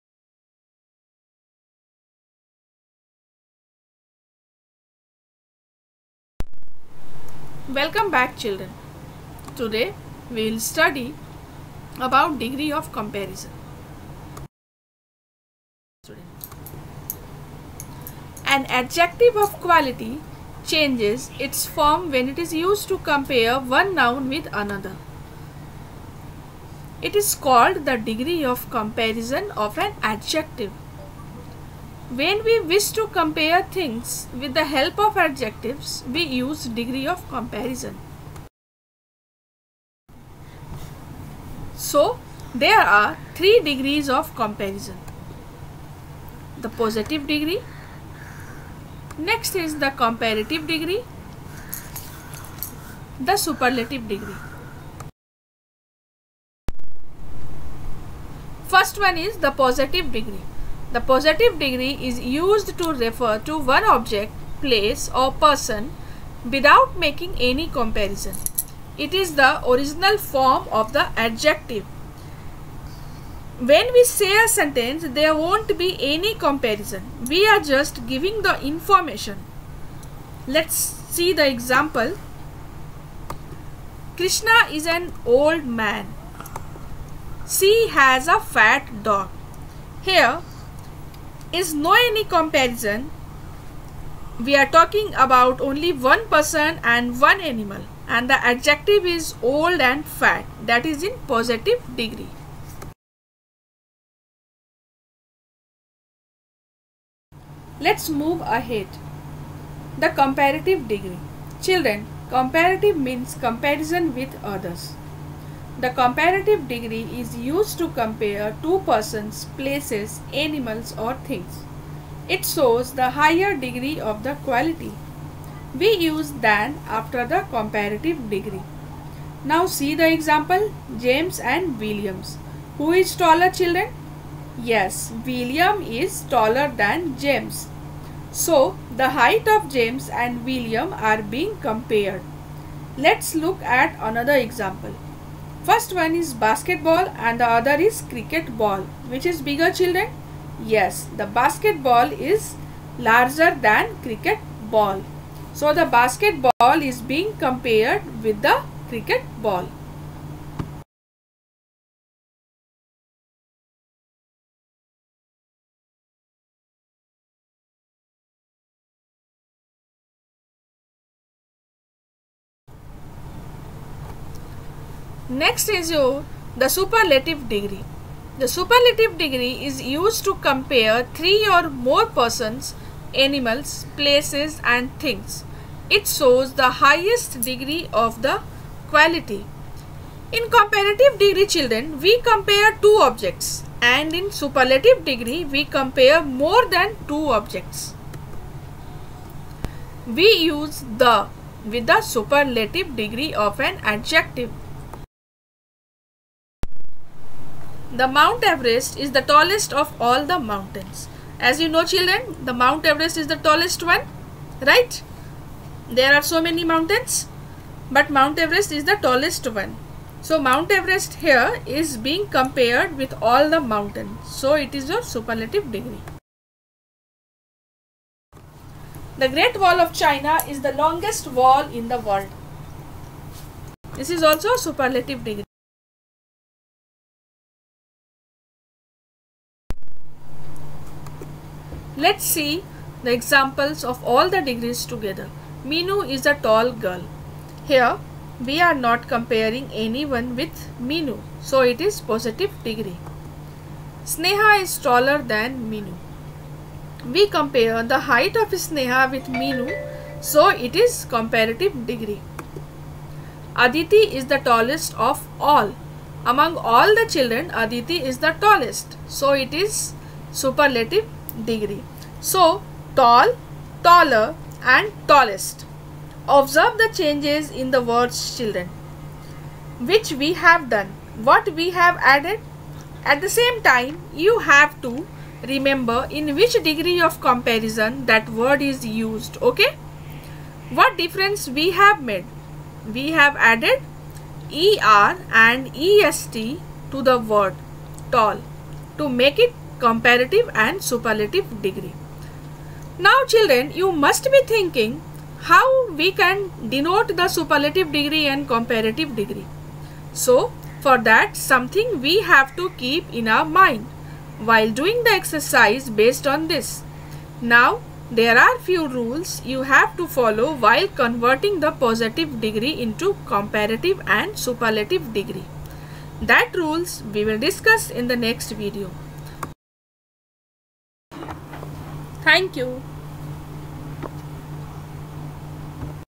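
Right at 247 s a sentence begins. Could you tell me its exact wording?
Here we are not comparing anyone with Minu.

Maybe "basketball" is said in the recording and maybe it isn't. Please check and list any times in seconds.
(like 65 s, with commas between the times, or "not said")
146 s, 151 s, 155 s.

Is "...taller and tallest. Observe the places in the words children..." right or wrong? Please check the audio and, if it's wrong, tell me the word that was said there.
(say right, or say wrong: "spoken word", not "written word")
wrong: "changes", not "places".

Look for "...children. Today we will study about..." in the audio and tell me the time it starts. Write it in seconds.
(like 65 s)
8 s.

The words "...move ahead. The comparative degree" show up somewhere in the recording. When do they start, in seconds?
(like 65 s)
108 s.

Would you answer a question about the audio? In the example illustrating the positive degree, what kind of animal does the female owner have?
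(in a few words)
A fat dog.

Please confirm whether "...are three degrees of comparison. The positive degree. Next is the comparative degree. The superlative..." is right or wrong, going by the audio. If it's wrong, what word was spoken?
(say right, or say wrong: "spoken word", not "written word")
right.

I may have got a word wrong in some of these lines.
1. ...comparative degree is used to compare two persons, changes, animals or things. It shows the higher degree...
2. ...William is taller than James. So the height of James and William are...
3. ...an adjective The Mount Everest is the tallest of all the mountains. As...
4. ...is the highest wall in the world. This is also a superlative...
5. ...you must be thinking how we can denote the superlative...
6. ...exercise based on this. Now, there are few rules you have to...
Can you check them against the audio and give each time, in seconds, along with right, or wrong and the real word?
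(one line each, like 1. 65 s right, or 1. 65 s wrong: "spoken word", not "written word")
1. 115 s wrong: "places", not "changes"
2. 135 s right
3. 203 s right
4. 230 s wrong: "longest", not "highest"
5. 303 s right
6. 315 s right.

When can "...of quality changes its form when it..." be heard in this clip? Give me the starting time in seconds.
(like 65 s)
19 s.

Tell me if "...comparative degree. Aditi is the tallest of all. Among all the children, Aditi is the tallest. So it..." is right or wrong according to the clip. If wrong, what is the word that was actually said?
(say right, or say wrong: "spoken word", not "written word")
right.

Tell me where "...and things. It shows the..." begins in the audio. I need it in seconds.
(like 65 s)
184 s.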